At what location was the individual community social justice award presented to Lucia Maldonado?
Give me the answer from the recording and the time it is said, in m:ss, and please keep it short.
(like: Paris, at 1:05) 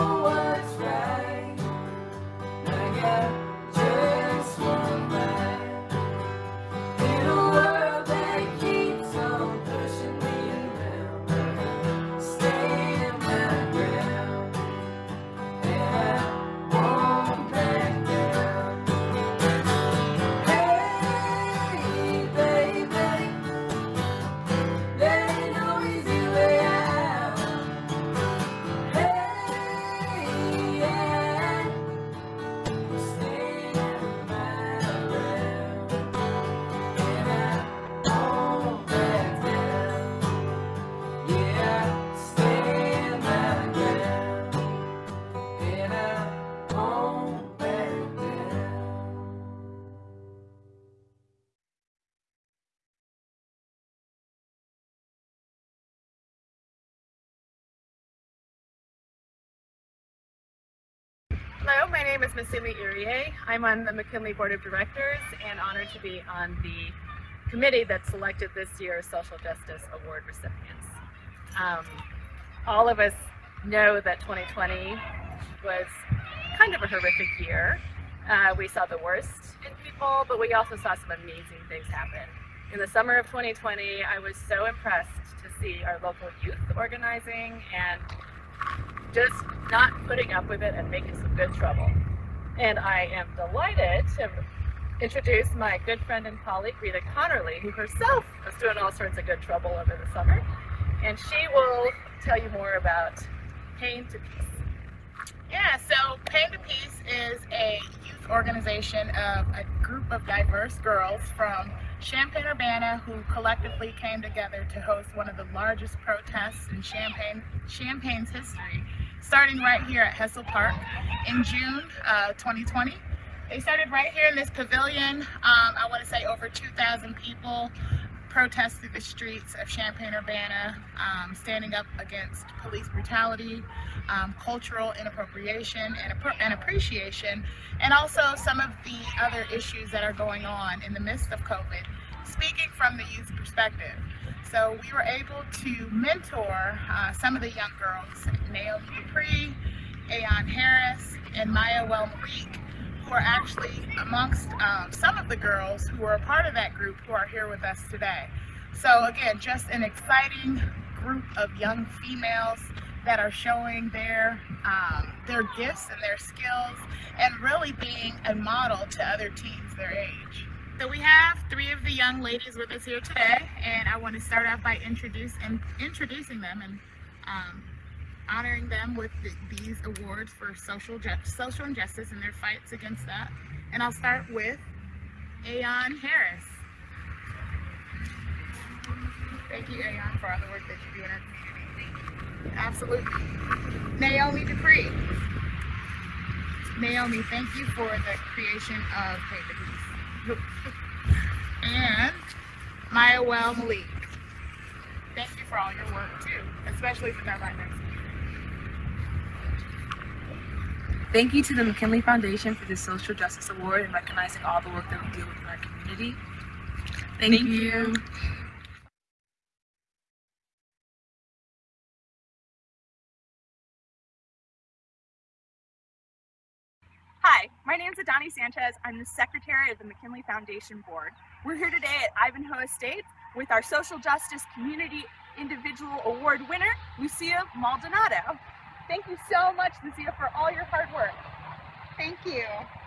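Ivanhoe Estates, at 3:52.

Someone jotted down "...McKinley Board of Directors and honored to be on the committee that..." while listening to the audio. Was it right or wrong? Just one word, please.
right.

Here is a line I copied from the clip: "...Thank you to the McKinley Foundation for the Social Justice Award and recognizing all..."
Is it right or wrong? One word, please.
right.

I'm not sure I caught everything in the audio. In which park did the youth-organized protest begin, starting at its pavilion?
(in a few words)
Hessel Park.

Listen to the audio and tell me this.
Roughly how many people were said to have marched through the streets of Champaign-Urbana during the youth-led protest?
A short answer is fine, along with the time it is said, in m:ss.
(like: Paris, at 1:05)
over 2,000, at 2:06.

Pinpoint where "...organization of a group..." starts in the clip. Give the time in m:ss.
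1:48.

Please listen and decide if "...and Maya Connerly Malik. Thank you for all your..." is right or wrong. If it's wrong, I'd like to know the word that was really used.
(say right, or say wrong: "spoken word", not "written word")
wrong: "Well", not "Connerly".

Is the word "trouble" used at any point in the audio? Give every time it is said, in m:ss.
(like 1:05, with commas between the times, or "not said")
1:31, 1:39.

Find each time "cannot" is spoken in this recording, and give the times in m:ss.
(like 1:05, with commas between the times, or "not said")
not said.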